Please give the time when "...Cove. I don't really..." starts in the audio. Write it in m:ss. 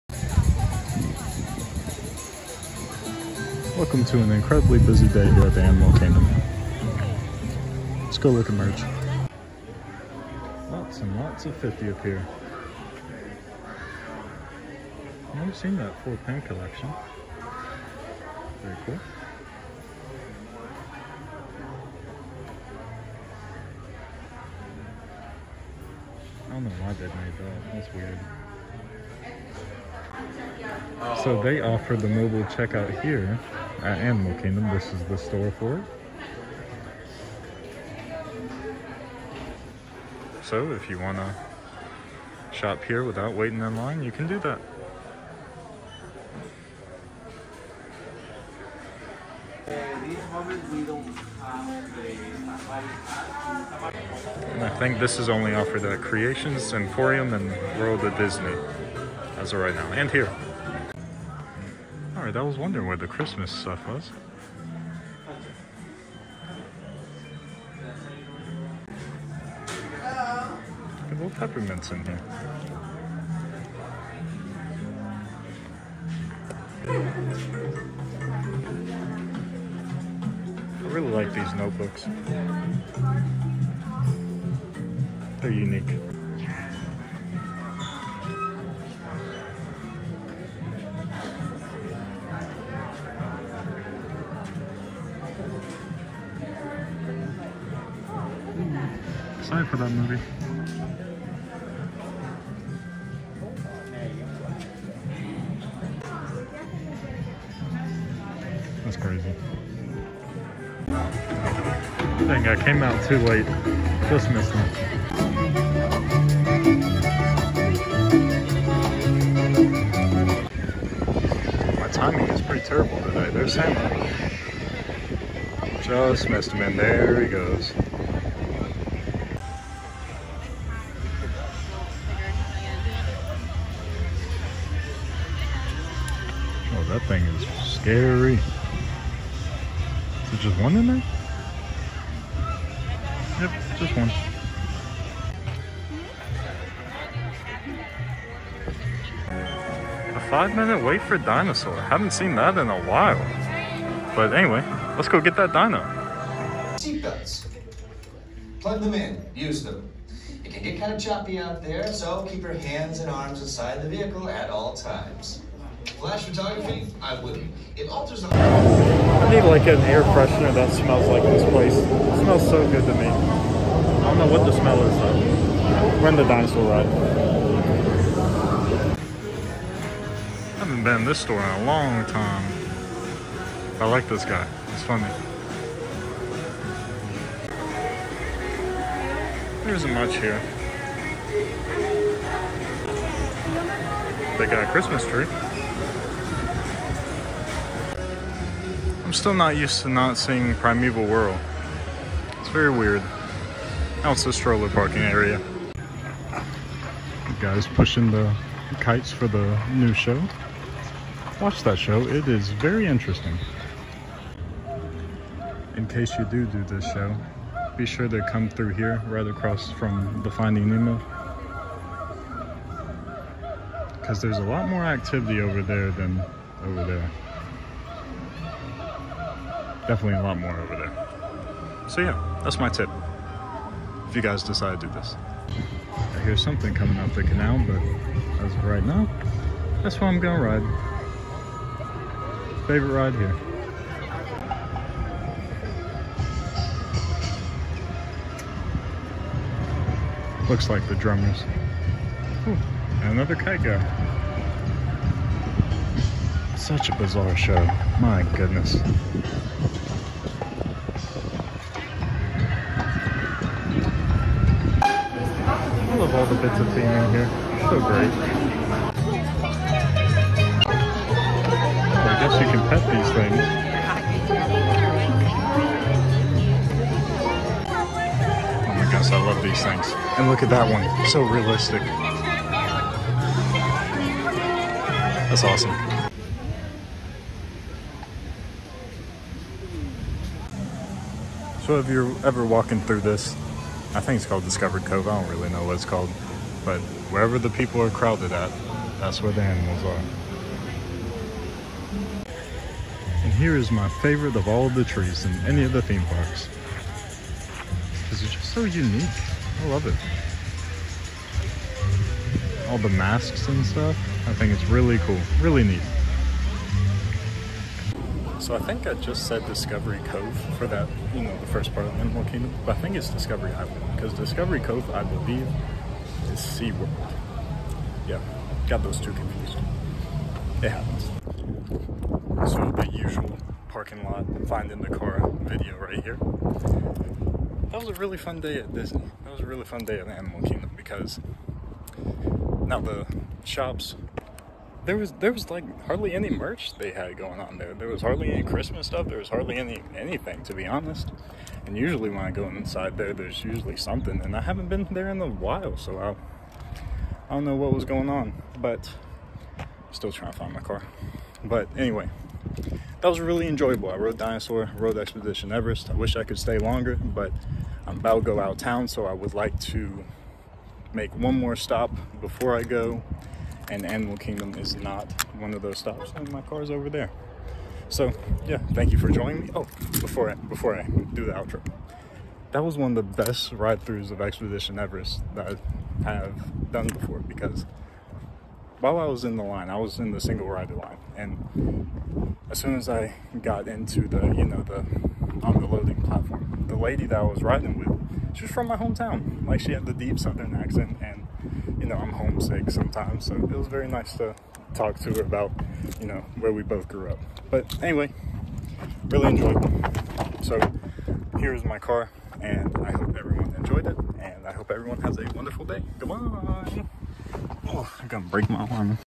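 4:54.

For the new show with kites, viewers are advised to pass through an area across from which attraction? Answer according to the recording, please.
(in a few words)
Finding Nemo.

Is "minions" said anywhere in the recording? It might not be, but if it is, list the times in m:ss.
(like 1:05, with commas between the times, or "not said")
not said.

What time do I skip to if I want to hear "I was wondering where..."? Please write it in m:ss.
1:02.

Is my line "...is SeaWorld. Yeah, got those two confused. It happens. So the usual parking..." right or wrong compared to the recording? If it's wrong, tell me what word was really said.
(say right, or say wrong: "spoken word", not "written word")
right.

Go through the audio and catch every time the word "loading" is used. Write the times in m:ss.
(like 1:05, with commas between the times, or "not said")
6:35.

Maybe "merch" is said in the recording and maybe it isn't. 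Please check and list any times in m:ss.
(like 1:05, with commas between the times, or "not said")
0:08, 5:46.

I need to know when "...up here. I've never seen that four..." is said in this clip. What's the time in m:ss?
0:11.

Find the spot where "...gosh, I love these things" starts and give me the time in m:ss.
4:38.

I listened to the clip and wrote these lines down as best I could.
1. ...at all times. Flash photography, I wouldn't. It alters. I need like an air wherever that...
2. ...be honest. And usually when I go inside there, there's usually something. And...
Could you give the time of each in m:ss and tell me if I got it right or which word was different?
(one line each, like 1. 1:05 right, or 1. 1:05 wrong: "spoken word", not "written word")
1. 2:44 wrong: "freshener", not "wherever"
2. 5:50 right.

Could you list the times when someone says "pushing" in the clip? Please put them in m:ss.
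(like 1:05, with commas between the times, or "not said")
3:27.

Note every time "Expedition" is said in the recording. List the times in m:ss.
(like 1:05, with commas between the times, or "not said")
6:04, 6:24.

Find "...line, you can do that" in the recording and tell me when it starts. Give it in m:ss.
0:43.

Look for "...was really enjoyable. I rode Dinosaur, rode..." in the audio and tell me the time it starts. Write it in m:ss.
6:03.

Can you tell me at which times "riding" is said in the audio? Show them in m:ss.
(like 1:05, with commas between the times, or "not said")
6:37.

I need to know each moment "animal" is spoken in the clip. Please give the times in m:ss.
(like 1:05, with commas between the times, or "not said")
0:05, 0:33, 4:59, 5:22, 5:40, 6:13.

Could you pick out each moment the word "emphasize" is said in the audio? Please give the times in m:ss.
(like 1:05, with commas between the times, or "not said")
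not said.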